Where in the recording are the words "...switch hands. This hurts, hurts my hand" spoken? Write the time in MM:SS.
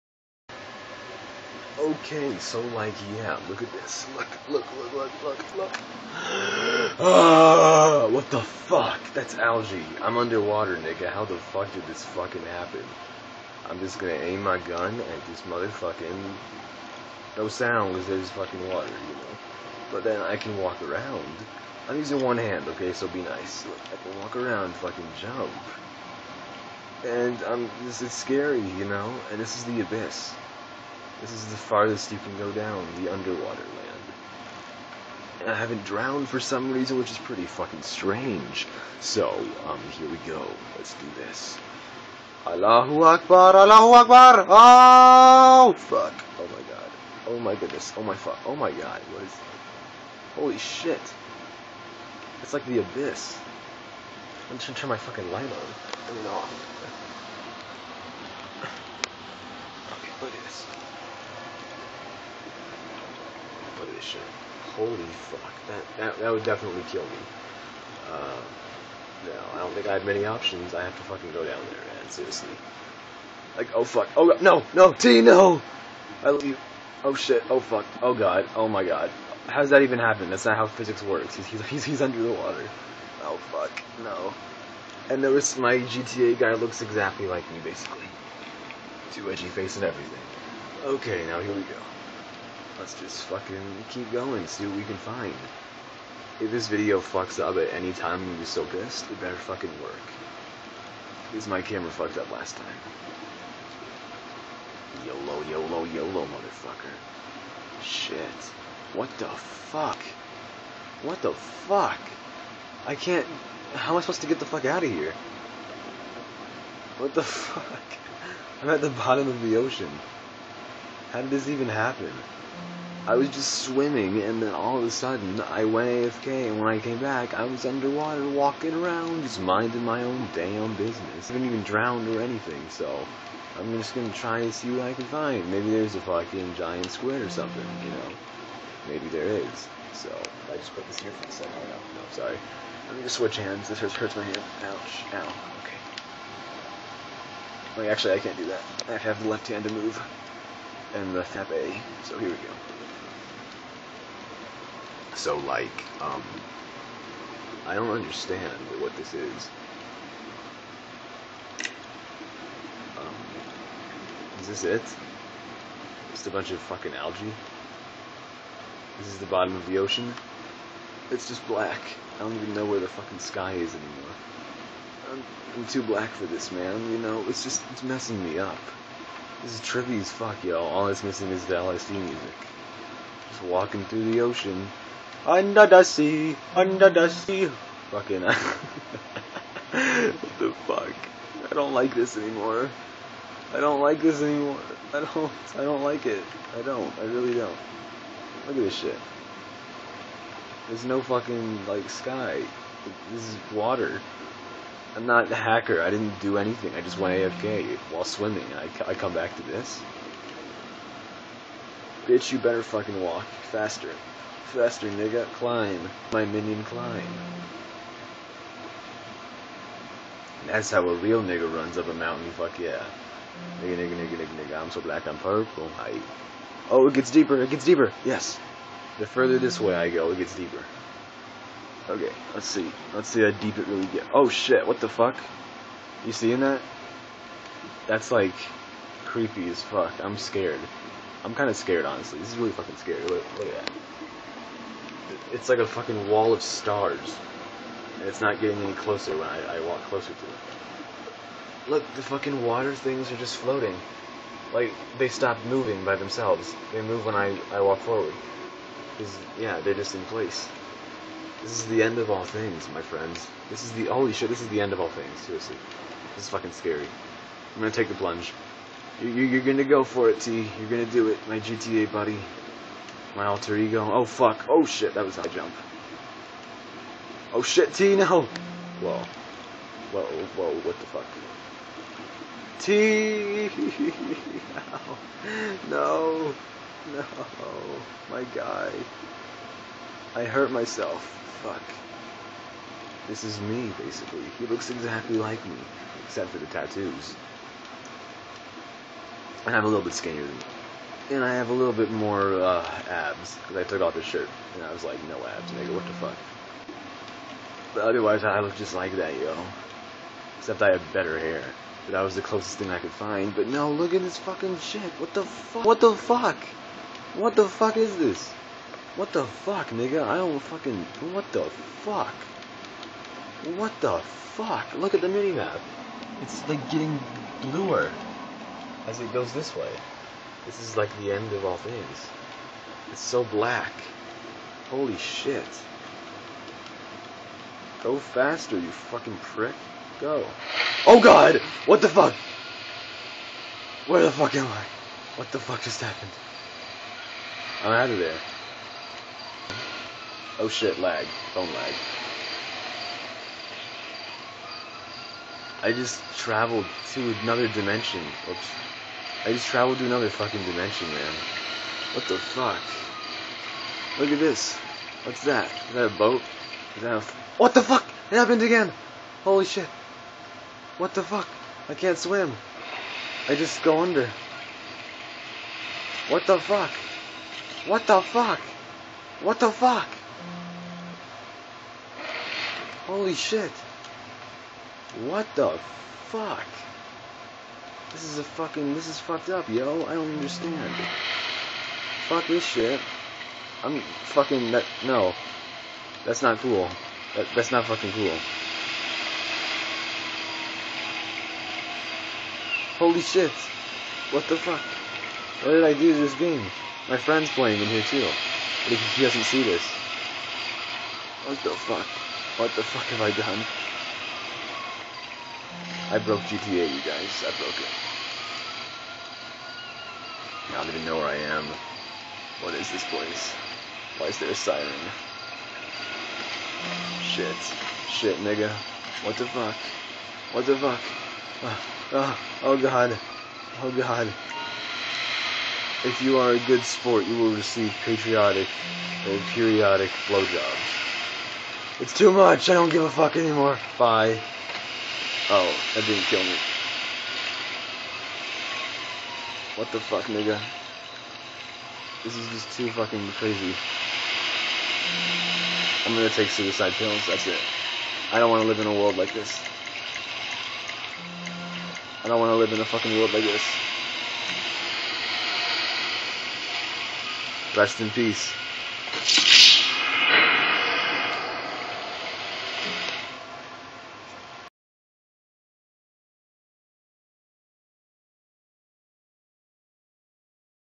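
02:23.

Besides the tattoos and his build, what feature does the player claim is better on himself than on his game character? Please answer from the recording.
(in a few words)
hair.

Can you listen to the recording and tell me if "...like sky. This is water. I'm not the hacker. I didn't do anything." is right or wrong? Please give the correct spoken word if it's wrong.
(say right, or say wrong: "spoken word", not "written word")
right.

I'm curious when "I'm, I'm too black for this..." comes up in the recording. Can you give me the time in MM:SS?
02:55.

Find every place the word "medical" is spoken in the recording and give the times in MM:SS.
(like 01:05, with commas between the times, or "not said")
not said.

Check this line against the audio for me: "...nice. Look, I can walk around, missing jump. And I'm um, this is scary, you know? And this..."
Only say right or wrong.
wrong.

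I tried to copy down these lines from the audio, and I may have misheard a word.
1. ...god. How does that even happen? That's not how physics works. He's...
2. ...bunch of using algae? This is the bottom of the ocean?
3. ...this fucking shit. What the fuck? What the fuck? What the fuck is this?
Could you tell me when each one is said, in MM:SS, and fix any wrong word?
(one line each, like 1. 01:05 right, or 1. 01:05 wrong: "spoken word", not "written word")
1. 01:18 right
2. 02:46 wrong: "fucking", not "using"
3. 05:14 right.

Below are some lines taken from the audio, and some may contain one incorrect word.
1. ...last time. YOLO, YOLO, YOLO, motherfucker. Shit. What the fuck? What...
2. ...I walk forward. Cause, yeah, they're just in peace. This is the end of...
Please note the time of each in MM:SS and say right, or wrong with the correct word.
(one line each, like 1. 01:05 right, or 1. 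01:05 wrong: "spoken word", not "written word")
1. 01:42 right
2. 04:17 wrong: "place", not "peace".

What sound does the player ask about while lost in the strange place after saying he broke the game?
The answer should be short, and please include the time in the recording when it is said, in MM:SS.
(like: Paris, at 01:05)
a siren, at 07:03.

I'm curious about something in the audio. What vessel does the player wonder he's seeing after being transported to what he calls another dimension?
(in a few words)
a boat.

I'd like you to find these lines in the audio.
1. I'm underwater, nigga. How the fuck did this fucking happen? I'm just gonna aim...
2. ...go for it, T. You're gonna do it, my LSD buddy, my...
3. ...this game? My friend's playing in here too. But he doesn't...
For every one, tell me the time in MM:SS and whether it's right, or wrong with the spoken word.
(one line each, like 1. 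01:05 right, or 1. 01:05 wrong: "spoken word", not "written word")
1. 00:09 right
2. 04:29 wrong: "GTA", not "LSD"
3. 06:45 right.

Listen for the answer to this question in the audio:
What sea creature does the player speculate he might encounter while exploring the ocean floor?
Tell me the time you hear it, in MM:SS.
02:16.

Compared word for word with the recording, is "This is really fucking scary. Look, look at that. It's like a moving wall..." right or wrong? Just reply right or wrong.
wrong.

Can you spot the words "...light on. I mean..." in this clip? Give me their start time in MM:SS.
00:55.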